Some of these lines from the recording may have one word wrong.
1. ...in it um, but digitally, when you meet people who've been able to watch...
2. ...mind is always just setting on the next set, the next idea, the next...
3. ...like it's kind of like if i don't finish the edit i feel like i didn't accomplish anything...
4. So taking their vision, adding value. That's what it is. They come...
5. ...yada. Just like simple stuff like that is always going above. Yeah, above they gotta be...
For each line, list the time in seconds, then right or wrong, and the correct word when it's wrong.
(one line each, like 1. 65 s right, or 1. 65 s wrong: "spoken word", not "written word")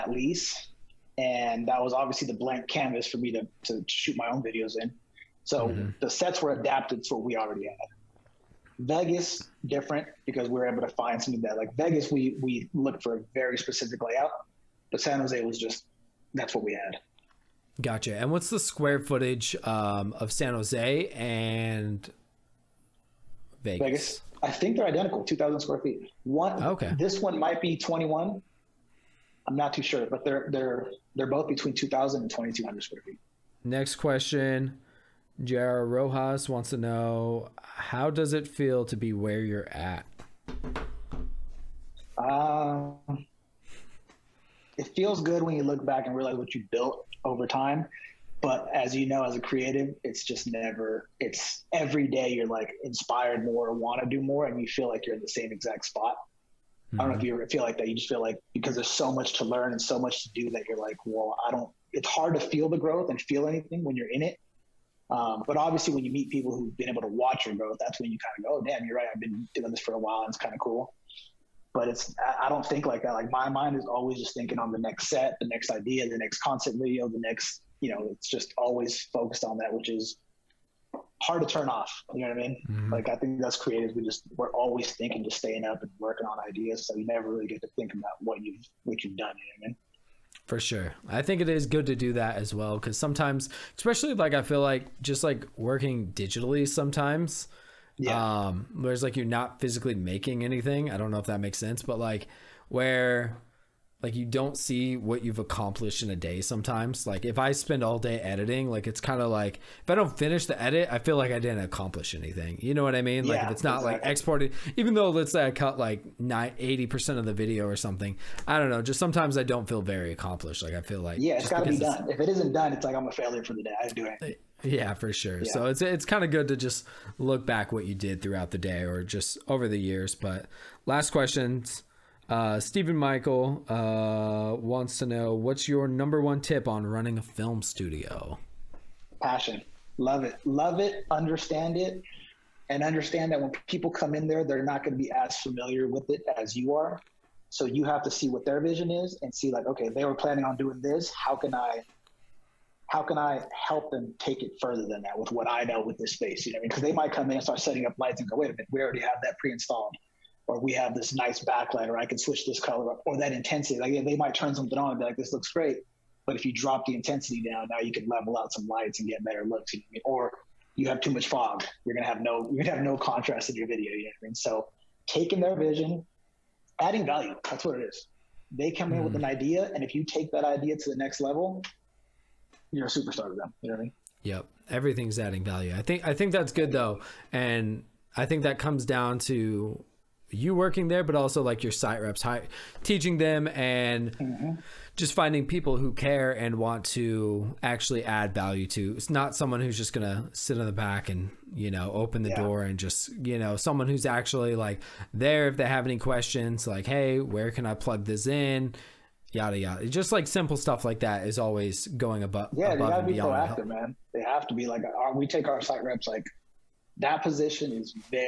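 1. 64 s wrong: "obviously", not "digitally"
2. 73 s wrong: "thinking", not "setting"
3. 108 s right
4. 174 s right
5. 209 s right.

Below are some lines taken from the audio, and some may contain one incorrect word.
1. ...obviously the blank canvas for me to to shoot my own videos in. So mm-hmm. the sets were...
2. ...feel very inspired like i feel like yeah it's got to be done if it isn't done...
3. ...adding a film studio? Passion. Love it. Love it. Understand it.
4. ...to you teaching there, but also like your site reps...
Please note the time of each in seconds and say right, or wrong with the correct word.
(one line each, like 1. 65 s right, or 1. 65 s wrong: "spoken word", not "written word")
1. 1 s right
2. 119 s wrong: "accomplished", not "inspired"
3. 136 s wrong: "running", not "adding"
4. 189 s wrong: "working", not "teaching".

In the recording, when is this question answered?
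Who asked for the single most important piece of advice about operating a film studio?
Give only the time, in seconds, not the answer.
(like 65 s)
132 s.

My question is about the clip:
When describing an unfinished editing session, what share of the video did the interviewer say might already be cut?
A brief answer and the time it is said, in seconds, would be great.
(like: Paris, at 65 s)
80%, at 116 s.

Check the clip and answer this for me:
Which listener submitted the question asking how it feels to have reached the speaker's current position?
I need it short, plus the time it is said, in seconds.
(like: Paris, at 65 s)
Jara Rojas, at 35 s.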